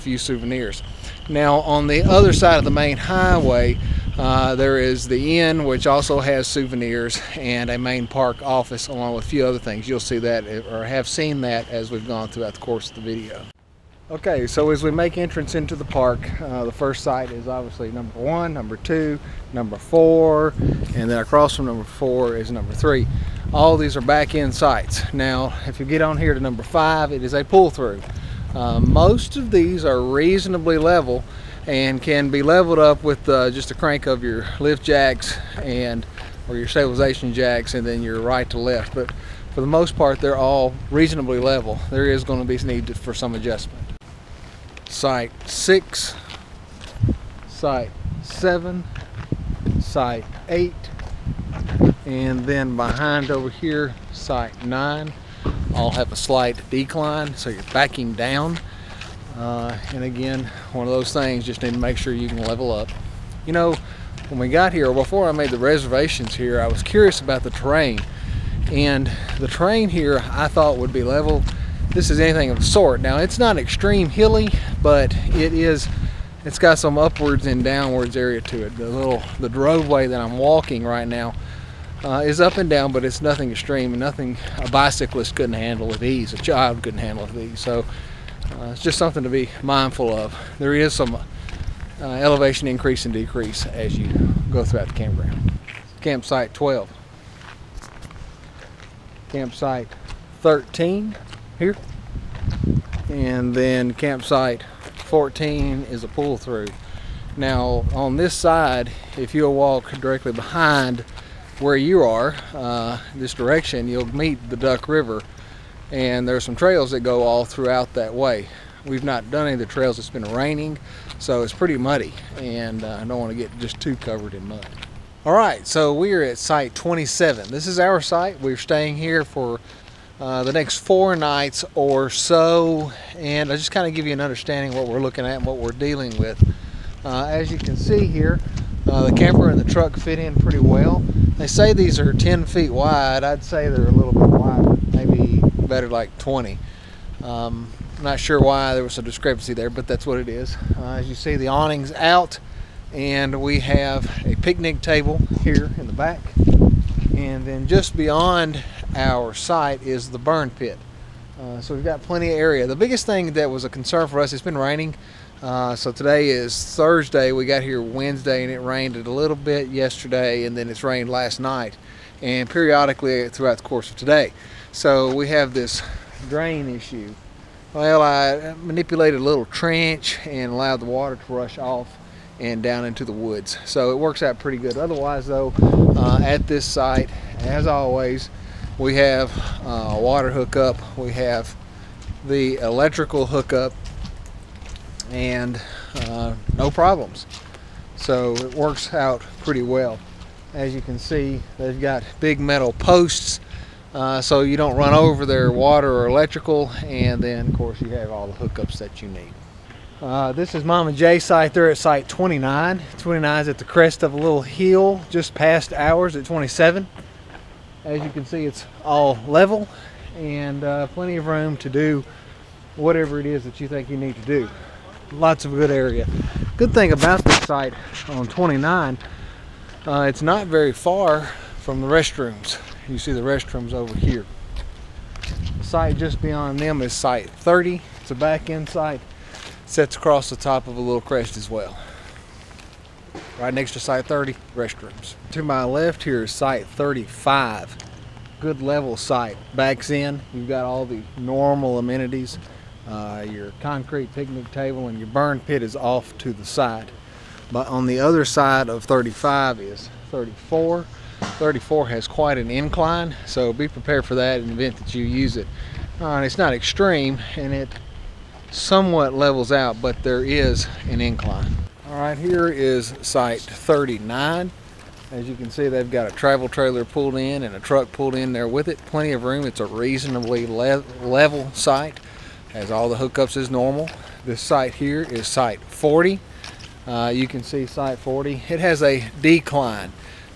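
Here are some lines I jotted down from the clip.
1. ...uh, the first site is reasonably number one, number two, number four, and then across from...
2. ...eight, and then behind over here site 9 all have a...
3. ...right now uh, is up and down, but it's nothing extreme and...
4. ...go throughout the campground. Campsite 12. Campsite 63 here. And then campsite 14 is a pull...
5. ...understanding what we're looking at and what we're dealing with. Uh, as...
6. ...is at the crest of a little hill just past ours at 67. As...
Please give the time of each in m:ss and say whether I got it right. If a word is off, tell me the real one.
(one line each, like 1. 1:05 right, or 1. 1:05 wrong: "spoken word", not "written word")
1. 0:16 wrong: "obviously", not "reasonably"
2. 0:50 right
3. 1:20 right
4. 1:34 wrong: "13", not "63"
5. 2:14 right
6. 3:33 wrong: "27", not "67".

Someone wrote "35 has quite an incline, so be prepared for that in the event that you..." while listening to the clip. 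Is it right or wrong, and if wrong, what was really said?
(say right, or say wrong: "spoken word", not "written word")
wrong: "34", not "35".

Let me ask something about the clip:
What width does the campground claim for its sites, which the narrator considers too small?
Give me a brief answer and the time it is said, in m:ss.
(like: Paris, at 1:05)
10 feet, at 2:22.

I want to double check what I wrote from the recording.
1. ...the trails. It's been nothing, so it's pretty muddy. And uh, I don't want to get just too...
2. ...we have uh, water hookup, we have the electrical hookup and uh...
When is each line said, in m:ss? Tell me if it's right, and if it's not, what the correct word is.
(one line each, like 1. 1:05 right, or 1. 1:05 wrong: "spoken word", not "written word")
1. 1:59 wrong: "raining", not "nothing"
2. 3:08 right.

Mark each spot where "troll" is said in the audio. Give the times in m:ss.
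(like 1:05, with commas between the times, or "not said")
not said.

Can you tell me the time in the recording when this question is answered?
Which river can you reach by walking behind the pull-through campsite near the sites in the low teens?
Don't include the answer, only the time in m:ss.
1:54.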